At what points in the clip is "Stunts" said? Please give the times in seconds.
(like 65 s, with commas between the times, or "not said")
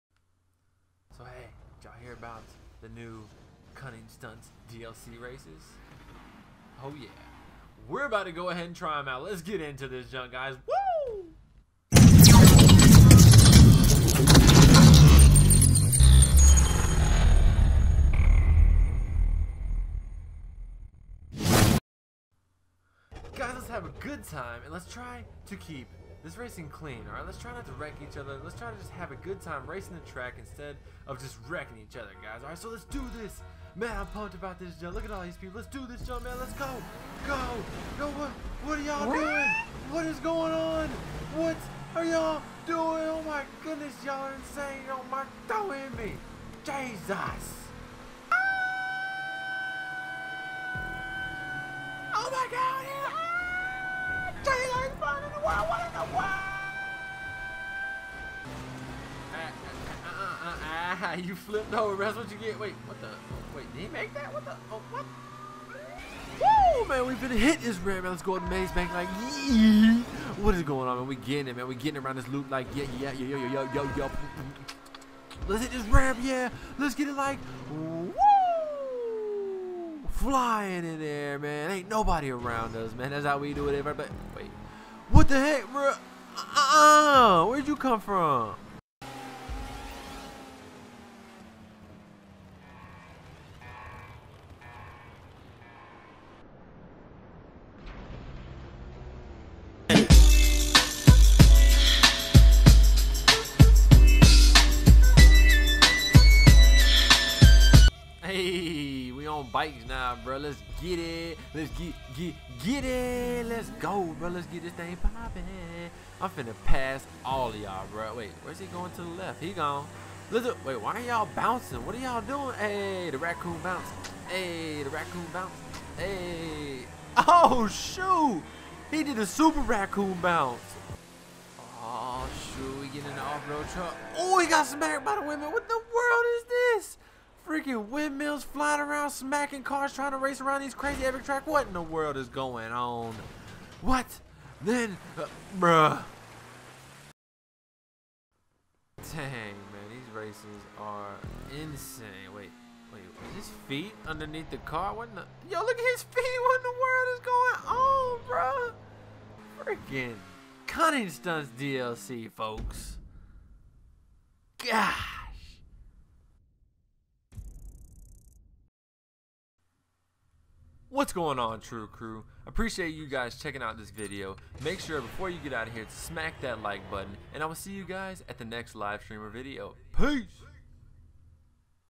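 4 s, 161 s.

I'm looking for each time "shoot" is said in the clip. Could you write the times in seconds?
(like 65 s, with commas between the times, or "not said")
127 s, 132 s.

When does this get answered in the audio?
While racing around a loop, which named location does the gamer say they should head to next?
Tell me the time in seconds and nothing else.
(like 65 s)
68 s.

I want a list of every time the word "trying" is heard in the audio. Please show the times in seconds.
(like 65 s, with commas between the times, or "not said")
139 s.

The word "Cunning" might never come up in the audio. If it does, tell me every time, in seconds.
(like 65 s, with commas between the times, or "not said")
3 s, 160 s.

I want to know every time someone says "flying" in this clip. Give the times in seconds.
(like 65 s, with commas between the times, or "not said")
80 s, 138 s.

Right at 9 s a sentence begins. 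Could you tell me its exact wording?
Let's get into this junk, guys.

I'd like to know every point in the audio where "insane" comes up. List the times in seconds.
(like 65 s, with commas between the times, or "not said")
44 s, 151 s.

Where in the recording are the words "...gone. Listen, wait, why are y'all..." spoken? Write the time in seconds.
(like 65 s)
119 s.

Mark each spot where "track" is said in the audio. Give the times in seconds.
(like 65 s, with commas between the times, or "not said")
30 s, 141 s.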